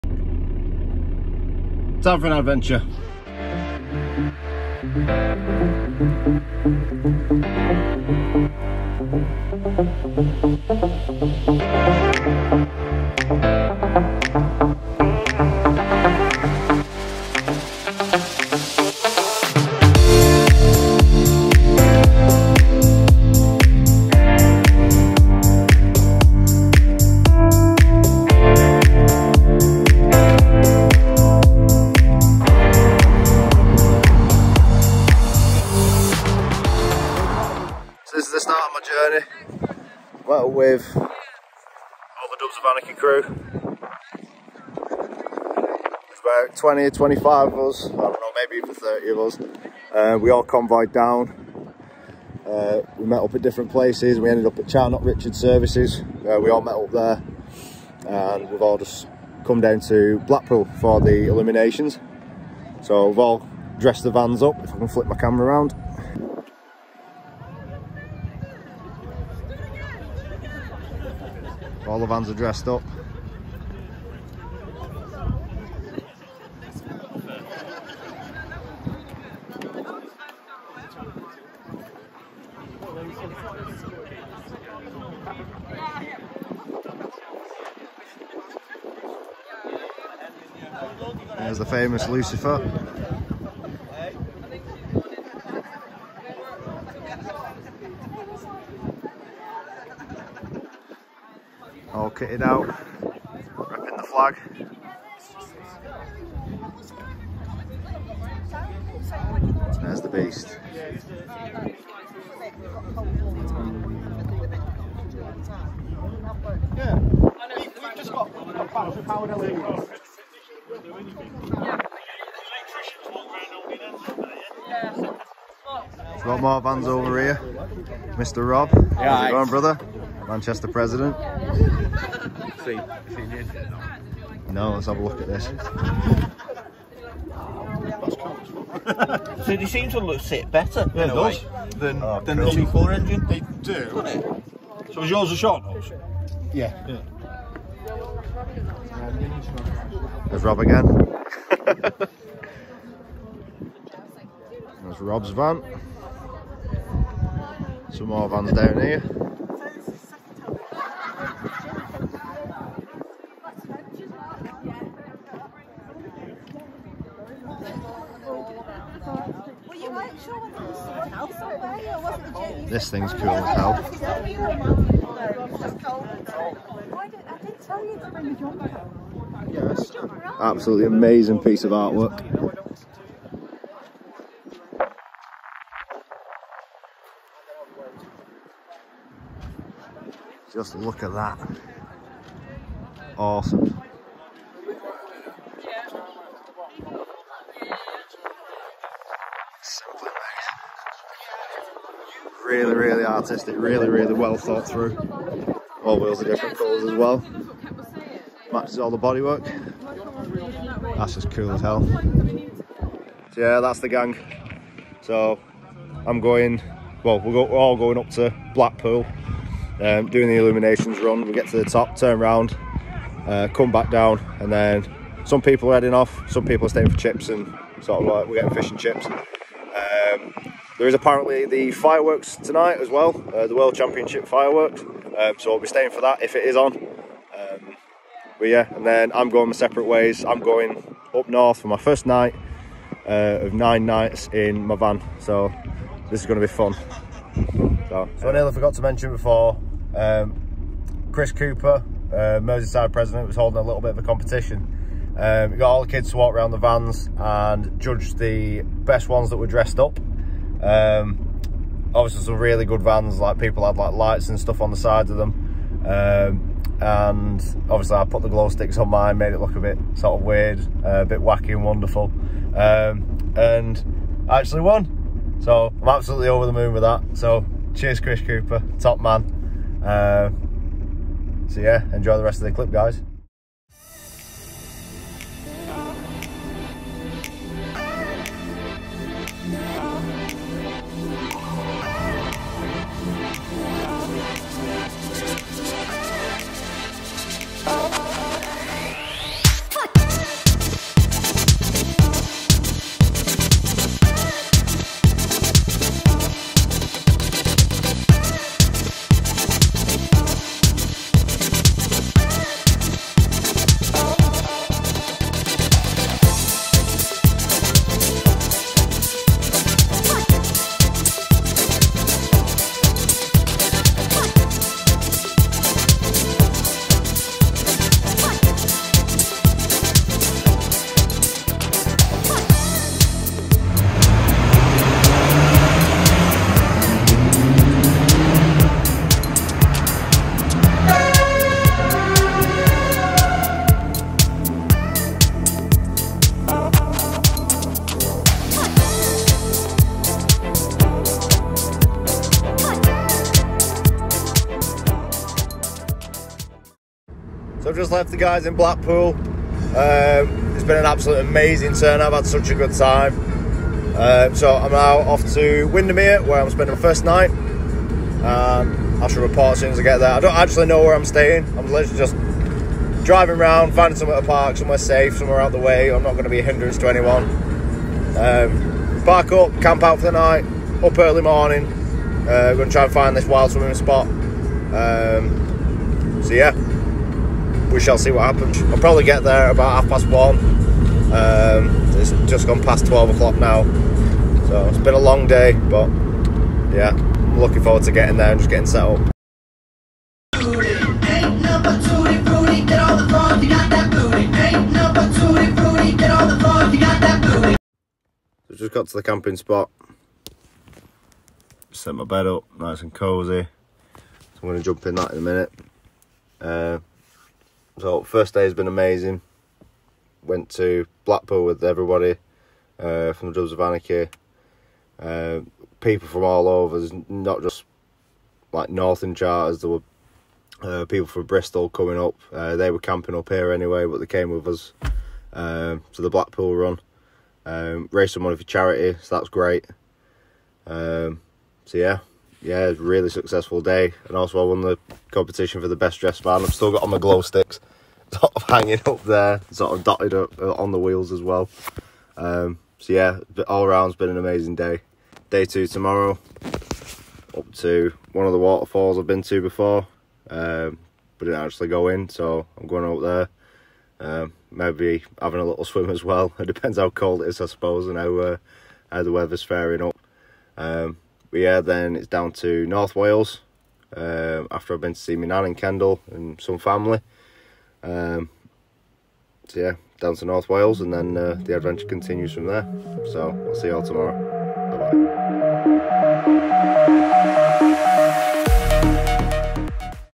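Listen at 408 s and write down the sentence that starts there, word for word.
So just got to the camping spot.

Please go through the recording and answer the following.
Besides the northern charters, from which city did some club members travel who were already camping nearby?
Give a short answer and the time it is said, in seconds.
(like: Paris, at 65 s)
Bristol, at 431 s.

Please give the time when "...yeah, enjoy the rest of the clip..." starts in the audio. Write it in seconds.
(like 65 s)
281 s.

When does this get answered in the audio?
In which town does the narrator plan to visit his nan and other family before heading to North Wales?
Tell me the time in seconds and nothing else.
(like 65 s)
475 s.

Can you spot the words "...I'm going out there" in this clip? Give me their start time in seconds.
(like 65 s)
462 s.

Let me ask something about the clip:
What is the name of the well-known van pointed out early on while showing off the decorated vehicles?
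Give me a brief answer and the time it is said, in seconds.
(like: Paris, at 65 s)
Lucifer, at 92 s.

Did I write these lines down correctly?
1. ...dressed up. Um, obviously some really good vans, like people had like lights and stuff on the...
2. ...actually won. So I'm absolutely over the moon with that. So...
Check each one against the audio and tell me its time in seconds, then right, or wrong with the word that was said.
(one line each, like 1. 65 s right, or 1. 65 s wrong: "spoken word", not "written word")
1. 259 s right
2. 274 s right.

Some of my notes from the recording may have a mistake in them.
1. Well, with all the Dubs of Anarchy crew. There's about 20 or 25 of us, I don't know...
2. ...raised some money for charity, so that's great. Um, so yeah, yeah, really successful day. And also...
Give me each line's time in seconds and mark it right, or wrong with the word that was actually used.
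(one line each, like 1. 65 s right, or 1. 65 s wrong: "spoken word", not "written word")
1. 40 s right
2. 437 s right.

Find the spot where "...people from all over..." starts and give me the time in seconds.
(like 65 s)
425 s.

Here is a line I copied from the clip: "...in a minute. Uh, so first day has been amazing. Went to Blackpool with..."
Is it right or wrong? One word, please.
right.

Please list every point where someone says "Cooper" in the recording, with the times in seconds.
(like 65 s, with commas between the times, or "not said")
251 s, 278 s.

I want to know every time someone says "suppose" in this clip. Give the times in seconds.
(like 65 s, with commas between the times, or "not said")
467 s.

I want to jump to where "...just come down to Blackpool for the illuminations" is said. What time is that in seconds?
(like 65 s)
58 s.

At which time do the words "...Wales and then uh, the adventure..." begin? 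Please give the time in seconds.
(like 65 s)
480 s.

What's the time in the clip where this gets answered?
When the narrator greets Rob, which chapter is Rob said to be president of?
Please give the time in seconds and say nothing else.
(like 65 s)
130 s.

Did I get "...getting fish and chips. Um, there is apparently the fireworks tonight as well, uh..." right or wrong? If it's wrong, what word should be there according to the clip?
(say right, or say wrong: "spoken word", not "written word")
right.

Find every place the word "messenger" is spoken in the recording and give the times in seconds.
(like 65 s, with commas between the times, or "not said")
not said.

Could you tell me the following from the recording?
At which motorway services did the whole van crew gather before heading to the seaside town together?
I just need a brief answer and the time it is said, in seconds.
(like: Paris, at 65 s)
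Charnock Richard Services, at 54 s.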